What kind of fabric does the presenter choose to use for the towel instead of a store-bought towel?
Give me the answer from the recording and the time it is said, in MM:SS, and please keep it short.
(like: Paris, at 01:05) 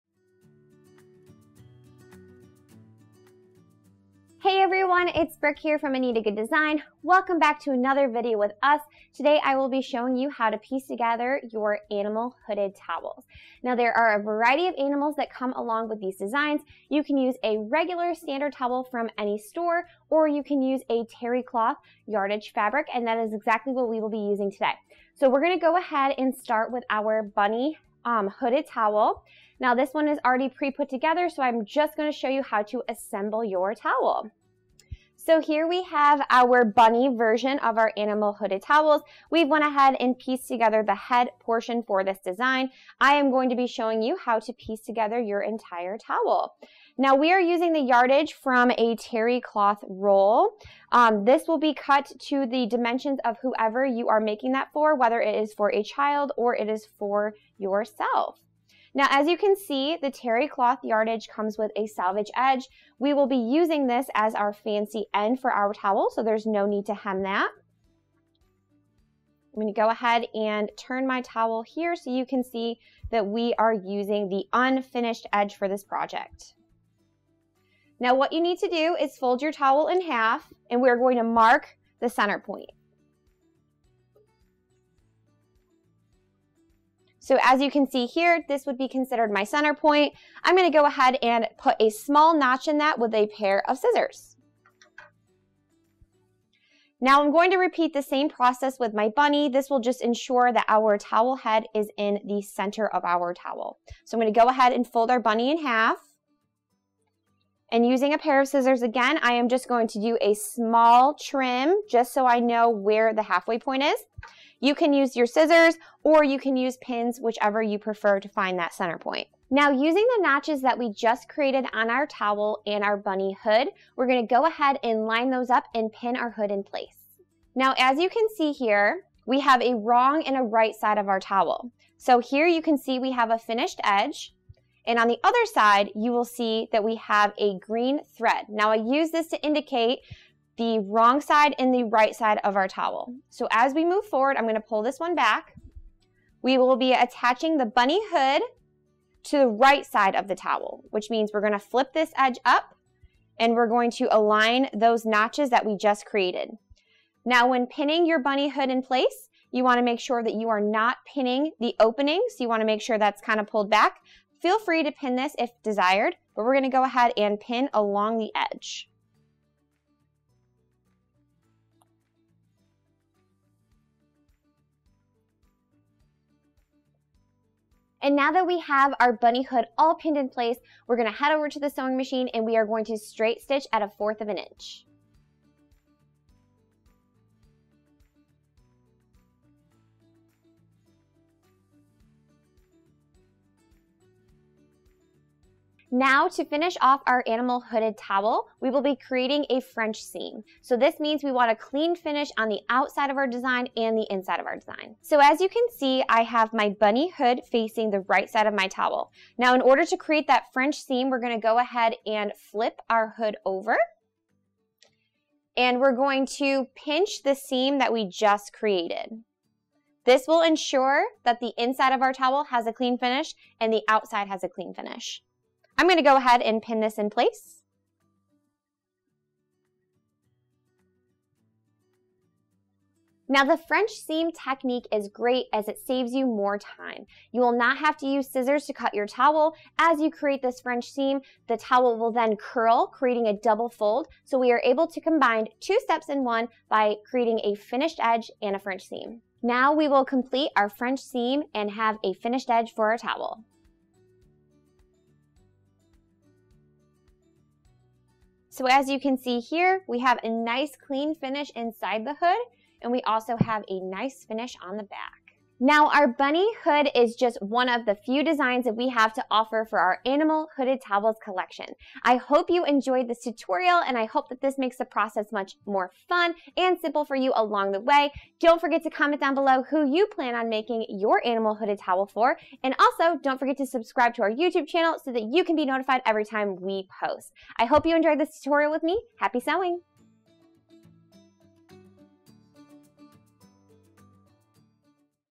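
Terry cloth yardage fabric, at 00:21.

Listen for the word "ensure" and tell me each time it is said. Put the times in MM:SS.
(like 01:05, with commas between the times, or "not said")
01:40, 03:40.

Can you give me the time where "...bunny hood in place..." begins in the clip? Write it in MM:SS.
02:38.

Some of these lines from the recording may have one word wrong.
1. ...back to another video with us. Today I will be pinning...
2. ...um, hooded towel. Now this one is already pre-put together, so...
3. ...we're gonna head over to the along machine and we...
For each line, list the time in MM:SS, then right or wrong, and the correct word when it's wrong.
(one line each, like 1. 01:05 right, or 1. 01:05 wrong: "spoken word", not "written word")
1. 00:07 wrong: "showing", not "pinning"
2. 00:28 right
3. 03:00 wrong: "sewing", not "along".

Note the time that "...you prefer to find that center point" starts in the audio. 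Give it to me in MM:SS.
01:57.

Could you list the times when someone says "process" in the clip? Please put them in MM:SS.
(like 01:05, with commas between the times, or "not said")
01:38, 04:34.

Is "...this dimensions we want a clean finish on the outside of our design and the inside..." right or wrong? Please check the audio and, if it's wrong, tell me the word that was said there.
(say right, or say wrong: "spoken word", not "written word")
wrong: "means", not "dimensions".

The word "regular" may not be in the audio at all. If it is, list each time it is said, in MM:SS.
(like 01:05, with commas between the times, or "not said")
00:17.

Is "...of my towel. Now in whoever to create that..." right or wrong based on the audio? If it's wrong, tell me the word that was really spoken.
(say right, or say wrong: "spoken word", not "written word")
wrong: "order", not "whoever".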